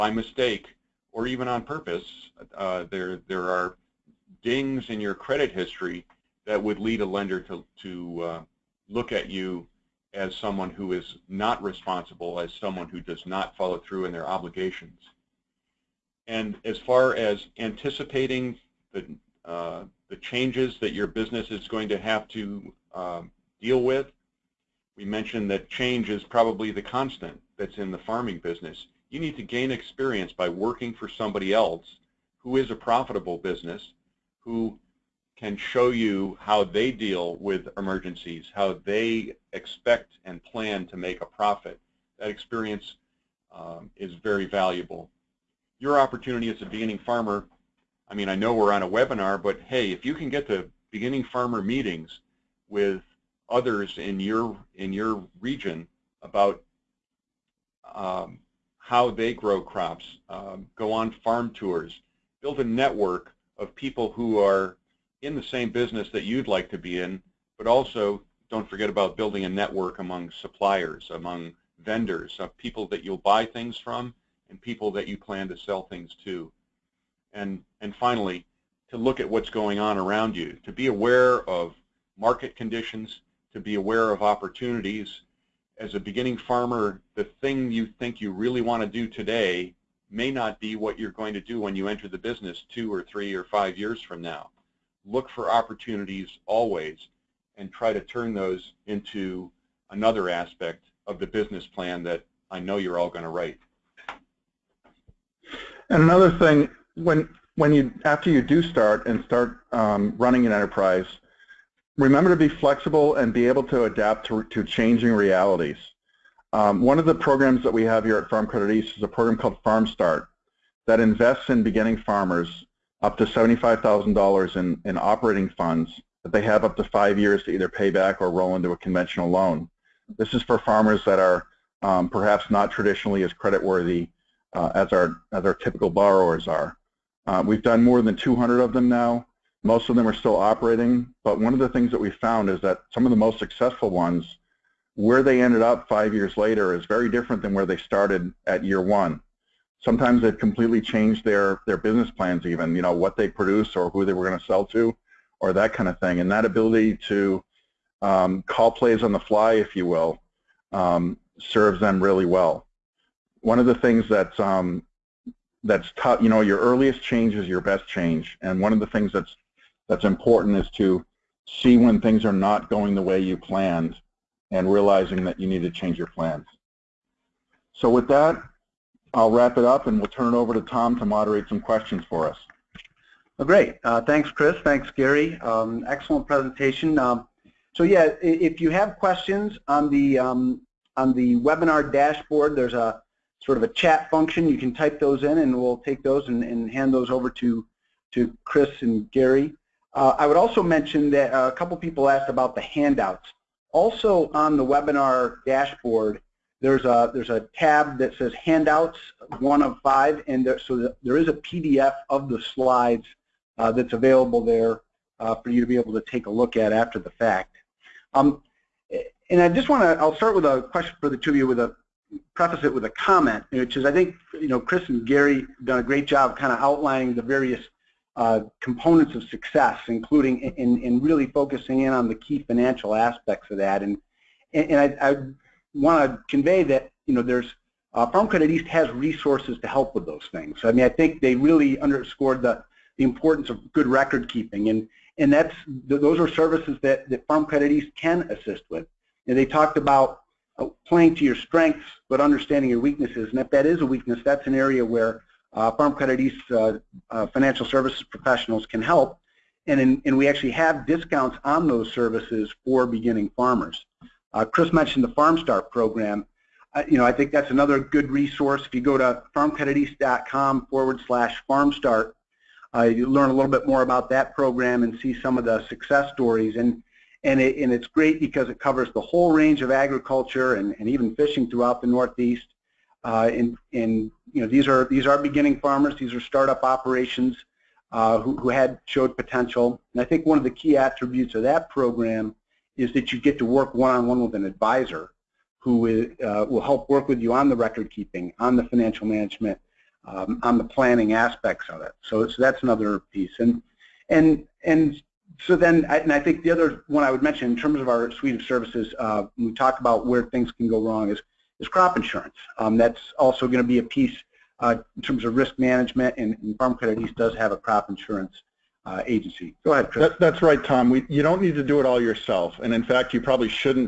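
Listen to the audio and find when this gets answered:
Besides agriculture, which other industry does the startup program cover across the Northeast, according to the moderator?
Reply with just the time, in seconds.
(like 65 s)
281 s.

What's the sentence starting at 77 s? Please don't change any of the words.
And, and finally, to look at what's going on around you, to be aware of market conditions, to be aware of opportunities.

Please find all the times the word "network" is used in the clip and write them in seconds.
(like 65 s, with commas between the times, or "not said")
62 s, 69 s.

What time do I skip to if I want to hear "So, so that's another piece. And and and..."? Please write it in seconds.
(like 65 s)
302 s.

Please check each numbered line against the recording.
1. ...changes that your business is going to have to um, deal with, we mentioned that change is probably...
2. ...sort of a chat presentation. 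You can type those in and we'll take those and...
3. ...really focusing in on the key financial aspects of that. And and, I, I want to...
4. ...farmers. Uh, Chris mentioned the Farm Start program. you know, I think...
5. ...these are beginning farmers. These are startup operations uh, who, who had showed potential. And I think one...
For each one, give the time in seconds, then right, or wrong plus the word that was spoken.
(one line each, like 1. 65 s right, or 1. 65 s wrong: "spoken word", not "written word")
1. 20 s right
2. 193 s wrong: "function", not "presentation"
3. 231 s right
4. 263 s right
5. 284 s right.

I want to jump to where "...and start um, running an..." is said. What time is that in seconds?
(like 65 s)
109 s.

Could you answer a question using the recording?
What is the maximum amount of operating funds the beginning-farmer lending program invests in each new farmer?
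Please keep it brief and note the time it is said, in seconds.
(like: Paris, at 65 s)
$75,000, at 123 s.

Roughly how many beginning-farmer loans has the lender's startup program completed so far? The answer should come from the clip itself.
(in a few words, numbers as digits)
more than 200.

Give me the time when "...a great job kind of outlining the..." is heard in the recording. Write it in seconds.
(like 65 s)
225 s.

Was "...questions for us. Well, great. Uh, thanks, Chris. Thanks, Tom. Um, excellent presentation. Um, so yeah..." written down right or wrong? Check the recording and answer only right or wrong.
wrong.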